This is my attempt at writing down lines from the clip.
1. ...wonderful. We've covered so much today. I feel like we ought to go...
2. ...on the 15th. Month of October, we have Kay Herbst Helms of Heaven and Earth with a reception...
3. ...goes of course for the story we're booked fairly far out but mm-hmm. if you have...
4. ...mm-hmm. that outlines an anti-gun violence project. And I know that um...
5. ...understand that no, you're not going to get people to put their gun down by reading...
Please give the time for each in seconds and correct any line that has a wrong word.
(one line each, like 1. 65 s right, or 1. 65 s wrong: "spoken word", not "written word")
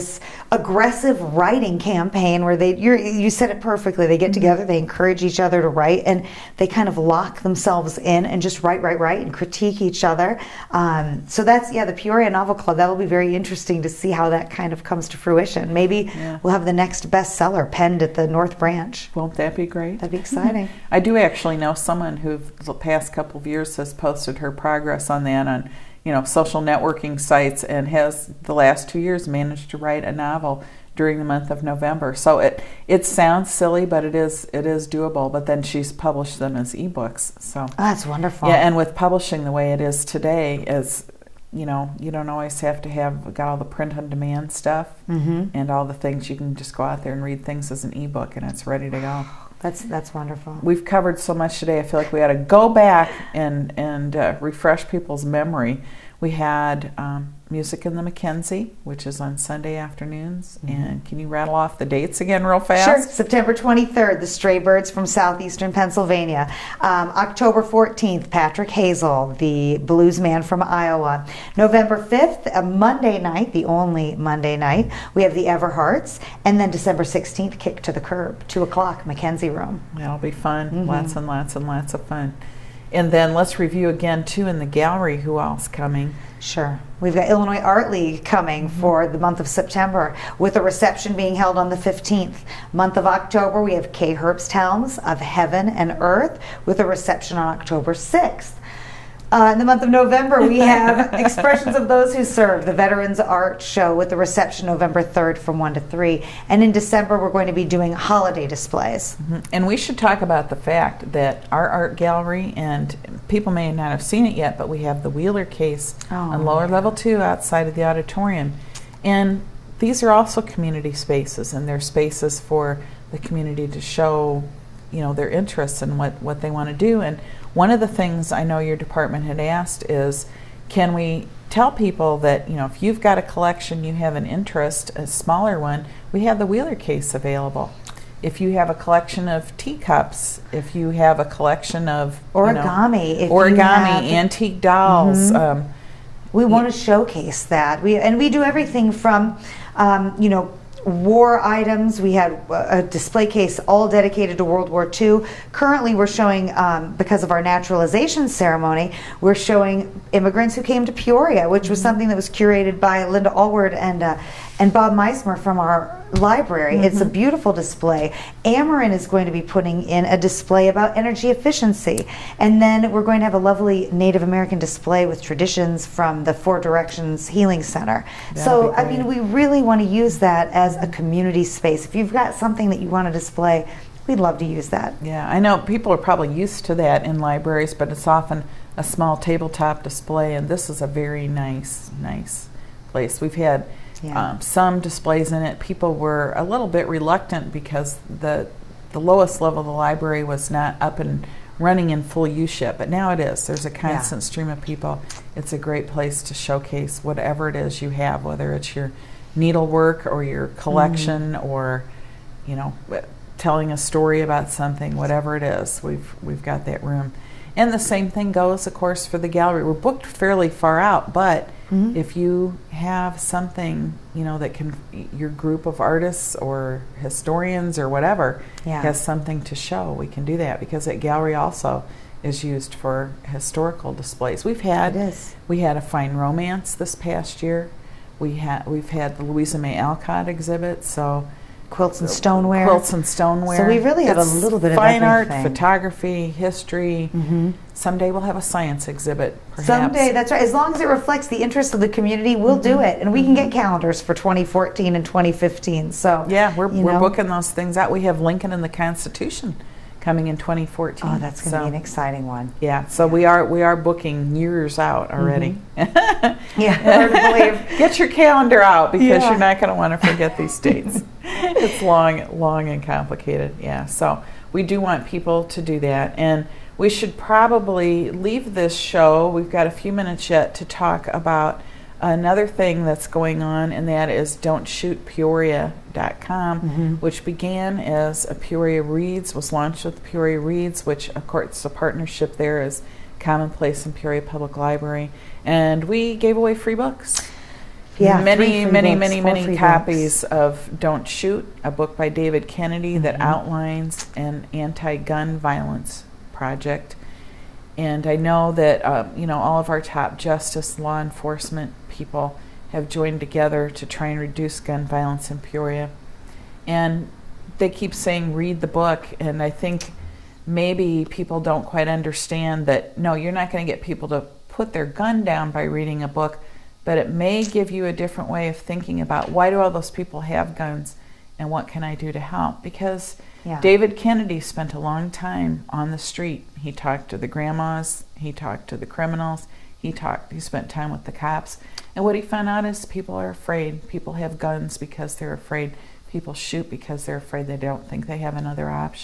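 1. 50 s right
2. 91 s right
3. 218 s wrong: "gallery", not "story"
4. 302 s right
5. 321 s right.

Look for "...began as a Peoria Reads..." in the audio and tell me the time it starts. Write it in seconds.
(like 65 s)
287 s.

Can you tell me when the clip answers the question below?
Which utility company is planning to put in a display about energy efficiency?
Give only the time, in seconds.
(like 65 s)
168 s.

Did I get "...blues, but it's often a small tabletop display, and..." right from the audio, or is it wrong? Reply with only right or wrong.
wrong.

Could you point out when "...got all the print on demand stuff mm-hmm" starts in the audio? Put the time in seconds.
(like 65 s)
43 s.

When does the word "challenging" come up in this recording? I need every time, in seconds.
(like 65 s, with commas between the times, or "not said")
not said.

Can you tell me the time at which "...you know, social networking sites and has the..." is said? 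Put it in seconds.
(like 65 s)
26 s.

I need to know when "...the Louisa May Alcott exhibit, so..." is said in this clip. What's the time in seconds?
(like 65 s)
239 s.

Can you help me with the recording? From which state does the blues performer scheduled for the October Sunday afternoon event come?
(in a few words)
Iowa.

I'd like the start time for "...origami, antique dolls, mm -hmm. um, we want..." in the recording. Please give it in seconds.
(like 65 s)
143 s.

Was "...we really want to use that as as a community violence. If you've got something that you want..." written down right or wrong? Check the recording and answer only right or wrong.
wrong.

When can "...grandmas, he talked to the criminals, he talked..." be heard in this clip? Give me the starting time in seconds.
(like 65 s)
337 s.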